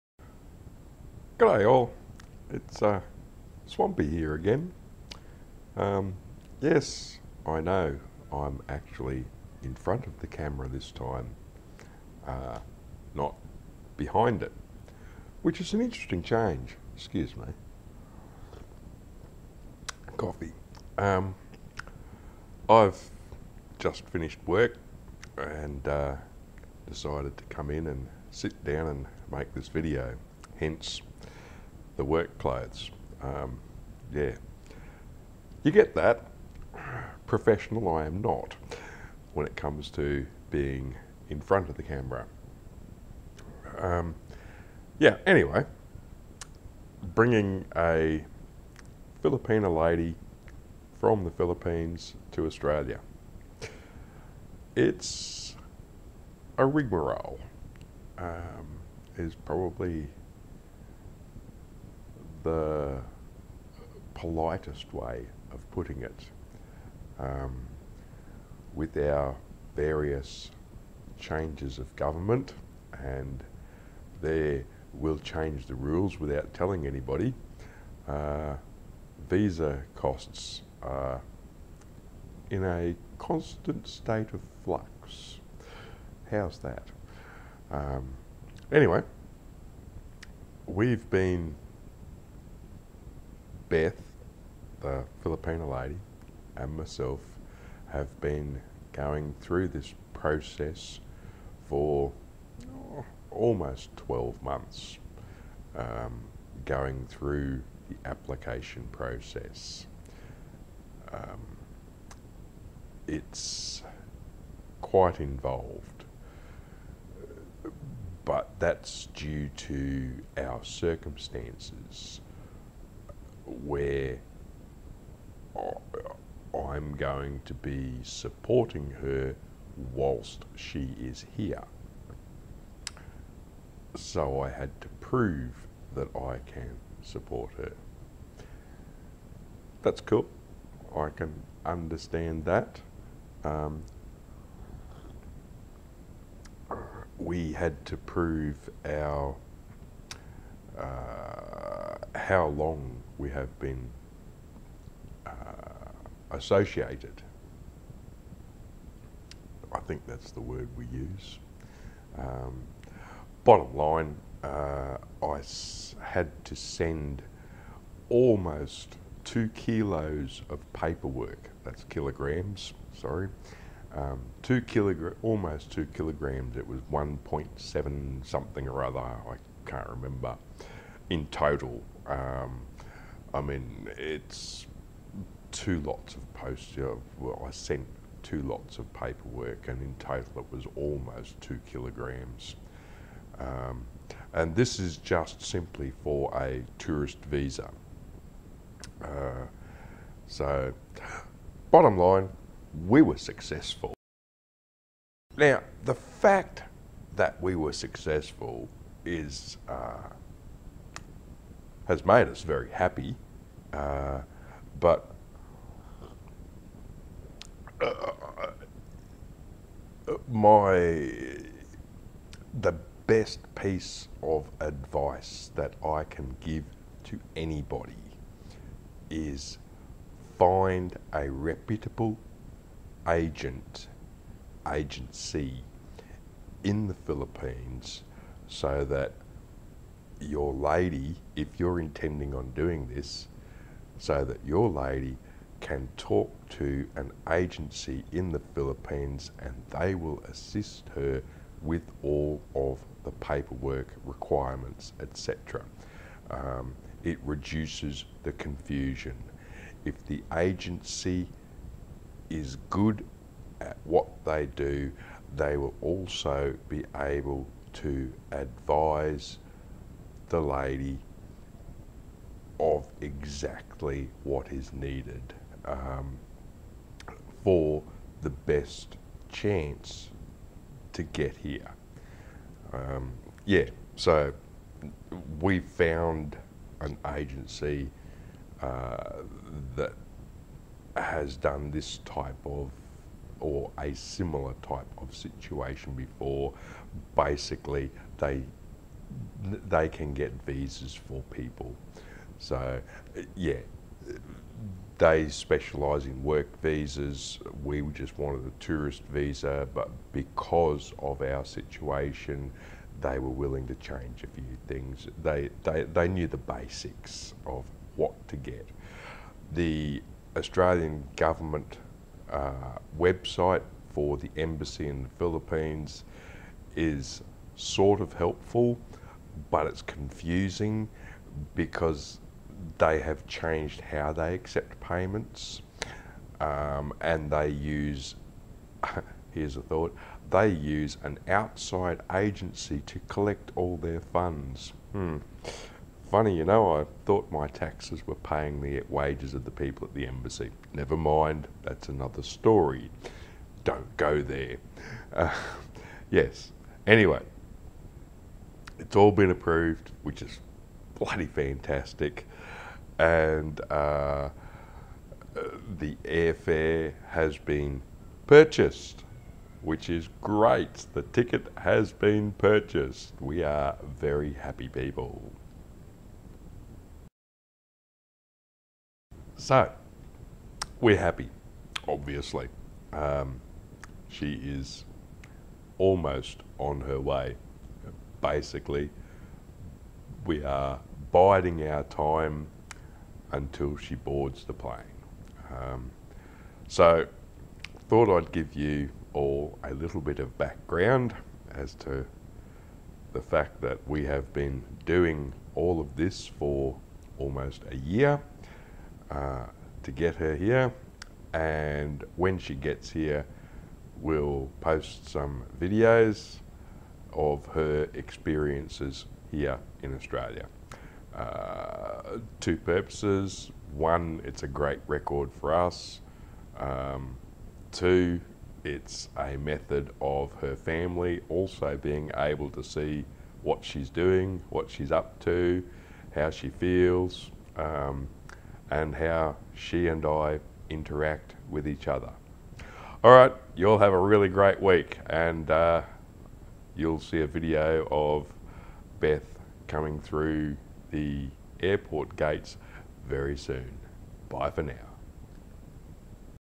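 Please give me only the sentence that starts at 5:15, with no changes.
They, they, they knew the basics of what to get.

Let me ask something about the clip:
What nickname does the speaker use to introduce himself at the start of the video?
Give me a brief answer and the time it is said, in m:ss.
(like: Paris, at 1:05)
Swampy, at 0:03.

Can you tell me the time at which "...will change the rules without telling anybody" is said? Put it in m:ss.
1:14.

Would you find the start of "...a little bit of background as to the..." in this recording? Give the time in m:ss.
6:39.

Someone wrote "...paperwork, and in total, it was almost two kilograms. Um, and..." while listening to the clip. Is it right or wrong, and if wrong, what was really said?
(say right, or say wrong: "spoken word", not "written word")
right.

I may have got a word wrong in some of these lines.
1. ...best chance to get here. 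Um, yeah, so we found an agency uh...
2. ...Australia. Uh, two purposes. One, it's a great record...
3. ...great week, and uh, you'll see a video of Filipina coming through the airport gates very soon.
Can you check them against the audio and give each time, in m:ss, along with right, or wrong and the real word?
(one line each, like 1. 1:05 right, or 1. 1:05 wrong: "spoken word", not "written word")
1. 4:38 right
2. 6:59 right
3. 7:24 wrong: "Beth", not "Filipina".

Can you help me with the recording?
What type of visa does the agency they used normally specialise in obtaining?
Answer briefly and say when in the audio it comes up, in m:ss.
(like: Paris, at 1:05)
work visas, at 5:06.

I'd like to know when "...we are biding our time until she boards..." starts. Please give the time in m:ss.
6:30.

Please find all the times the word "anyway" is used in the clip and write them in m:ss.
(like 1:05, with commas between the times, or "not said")
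0:45, 1:28, 5:56.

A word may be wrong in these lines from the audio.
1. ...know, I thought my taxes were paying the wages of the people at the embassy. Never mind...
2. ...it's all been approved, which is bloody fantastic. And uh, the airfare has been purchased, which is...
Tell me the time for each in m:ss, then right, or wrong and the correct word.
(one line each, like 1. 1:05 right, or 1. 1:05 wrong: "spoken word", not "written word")
1. 5:46 right
2. 5:58 right.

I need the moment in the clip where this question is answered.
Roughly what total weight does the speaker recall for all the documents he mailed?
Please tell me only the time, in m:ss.
2:56.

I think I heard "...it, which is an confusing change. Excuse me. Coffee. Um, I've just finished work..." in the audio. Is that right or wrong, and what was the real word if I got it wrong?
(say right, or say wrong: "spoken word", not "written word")
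wrong: "interesting", not "confusing".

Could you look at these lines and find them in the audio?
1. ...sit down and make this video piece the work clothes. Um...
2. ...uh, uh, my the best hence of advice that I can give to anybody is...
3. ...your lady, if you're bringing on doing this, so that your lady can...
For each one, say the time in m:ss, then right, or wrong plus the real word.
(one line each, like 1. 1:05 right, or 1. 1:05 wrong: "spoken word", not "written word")
1. 0:28 wrong: "hence", not "piece"
2. 3:37 wrong: "piece", not "hence"
3. 4:00 wrong: "intending", not "bringing".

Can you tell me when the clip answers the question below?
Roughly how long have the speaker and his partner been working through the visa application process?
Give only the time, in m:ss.
1:43.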